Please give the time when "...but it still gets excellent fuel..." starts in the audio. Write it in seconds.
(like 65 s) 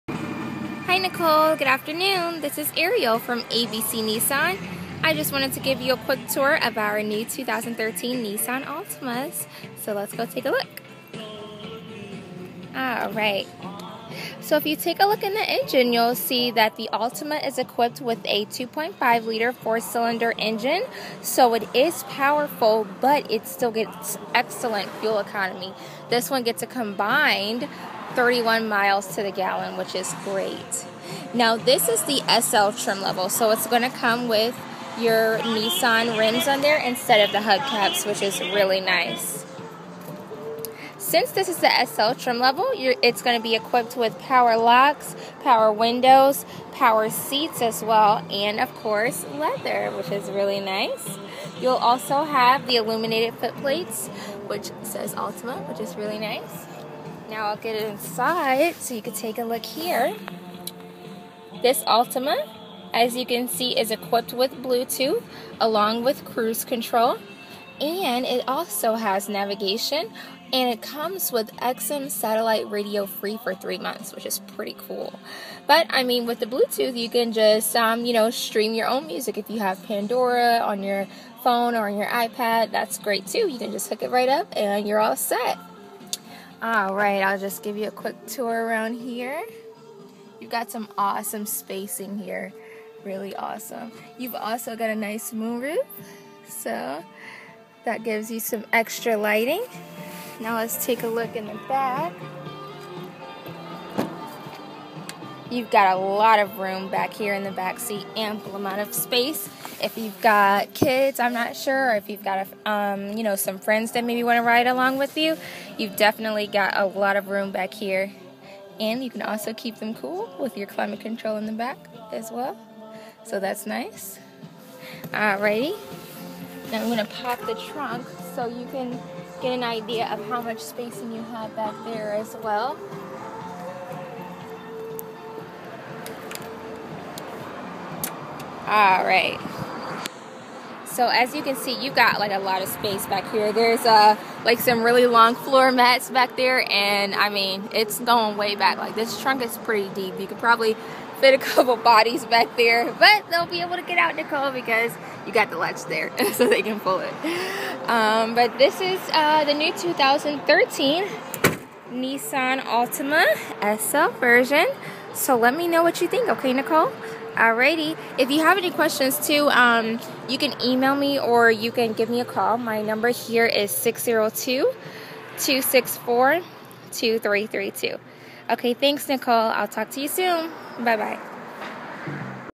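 22 s.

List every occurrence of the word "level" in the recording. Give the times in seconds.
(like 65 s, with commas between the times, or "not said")
33 s, 42 s.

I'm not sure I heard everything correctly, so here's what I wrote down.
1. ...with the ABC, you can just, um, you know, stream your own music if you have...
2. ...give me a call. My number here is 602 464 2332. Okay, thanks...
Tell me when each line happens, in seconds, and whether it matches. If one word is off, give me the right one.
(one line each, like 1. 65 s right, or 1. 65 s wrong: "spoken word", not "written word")
1. 76 s wrong: "Bluetooth", not "ABC"
2. 171 s wrong: "264", not "464".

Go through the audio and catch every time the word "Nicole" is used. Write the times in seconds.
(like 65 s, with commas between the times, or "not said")
0 s, 154 s, 166 s, 179 s.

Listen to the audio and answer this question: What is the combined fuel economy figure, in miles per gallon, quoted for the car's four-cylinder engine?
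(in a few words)
31.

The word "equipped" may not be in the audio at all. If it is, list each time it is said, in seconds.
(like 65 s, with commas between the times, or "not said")
17 s, 43 s, 63 s.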